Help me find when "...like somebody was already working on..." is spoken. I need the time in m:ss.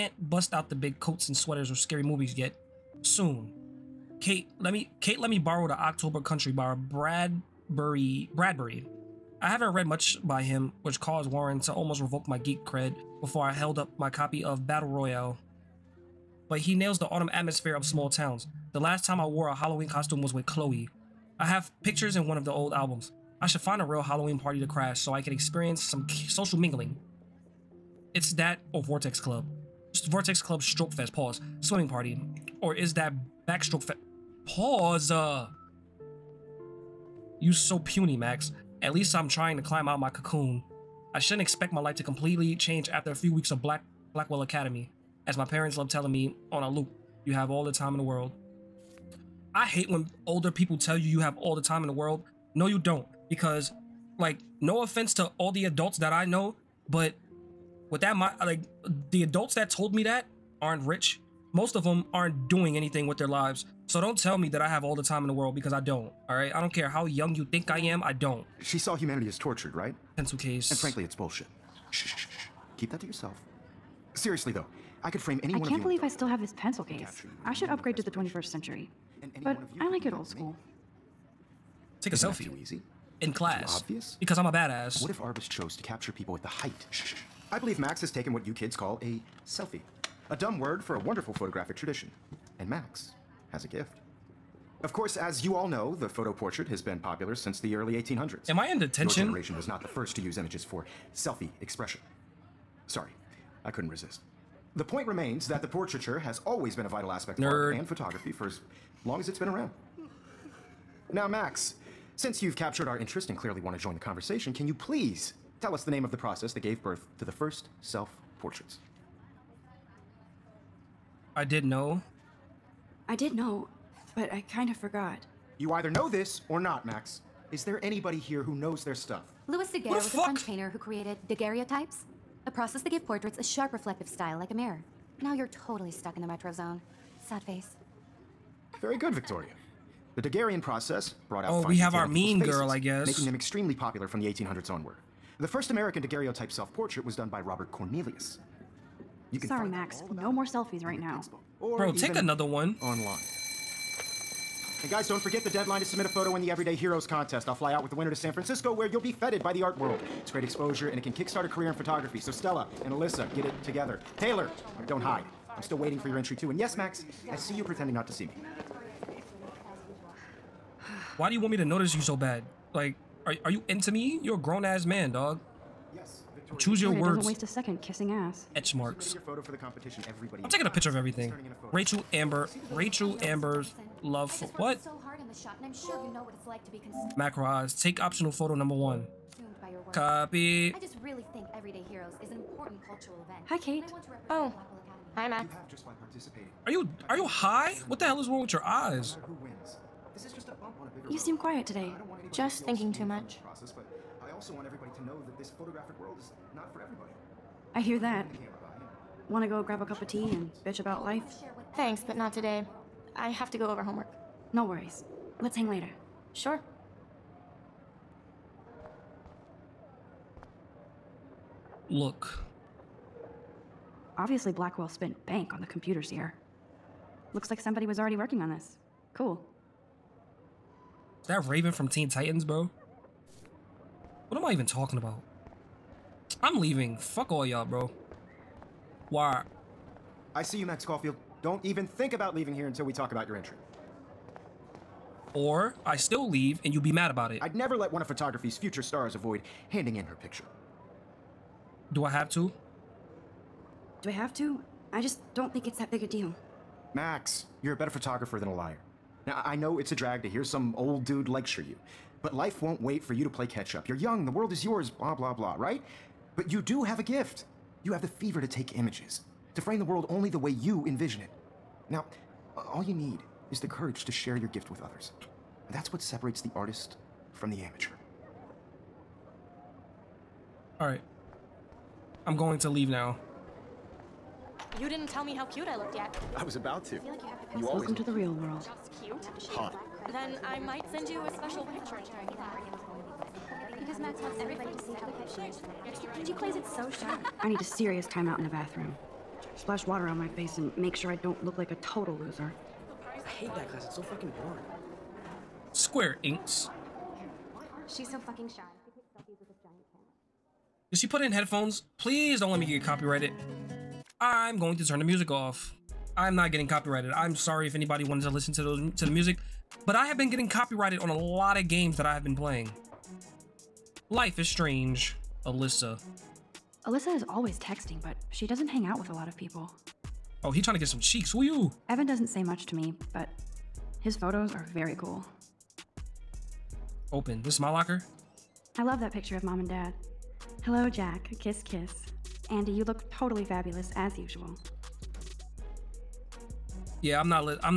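3:47.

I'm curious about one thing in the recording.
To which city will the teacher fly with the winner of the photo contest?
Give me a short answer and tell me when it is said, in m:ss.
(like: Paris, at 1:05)
San Francisco, at 2:38.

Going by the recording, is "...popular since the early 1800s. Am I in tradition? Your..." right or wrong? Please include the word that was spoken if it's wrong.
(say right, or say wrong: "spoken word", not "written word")
wrong: "detention", not "tradition".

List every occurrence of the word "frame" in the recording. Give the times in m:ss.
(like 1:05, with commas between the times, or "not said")
1:15, 4:29.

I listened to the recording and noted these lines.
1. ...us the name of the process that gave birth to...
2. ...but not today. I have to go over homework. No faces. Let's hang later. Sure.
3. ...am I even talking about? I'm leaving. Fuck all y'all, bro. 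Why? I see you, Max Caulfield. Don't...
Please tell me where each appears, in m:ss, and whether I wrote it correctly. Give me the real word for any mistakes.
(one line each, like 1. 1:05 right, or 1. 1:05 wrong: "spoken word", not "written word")
1. 1:55 right
2. 3:32 wrong: "worries", not "faces"
3. 3:54 right.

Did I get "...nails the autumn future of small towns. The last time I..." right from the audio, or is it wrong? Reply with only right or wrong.
wrong.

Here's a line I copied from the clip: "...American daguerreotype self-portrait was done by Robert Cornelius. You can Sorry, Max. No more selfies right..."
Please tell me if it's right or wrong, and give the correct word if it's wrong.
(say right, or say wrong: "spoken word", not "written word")
right.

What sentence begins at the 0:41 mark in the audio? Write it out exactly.
I shouldn't expect my life to completely change after a few weeks of Black Blackwell Academy.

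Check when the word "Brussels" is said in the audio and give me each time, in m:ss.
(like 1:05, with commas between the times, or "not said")
not said.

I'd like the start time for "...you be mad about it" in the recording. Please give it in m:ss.
4:06.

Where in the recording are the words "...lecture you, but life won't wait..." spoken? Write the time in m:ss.
4:21.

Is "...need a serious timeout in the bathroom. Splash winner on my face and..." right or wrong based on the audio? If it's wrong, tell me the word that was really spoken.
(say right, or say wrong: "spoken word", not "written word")
wrong: "water", not "winner".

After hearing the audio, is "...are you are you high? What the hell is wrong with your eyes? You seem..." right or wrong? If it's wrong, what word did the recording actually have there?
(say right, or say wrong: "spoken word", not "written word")
right.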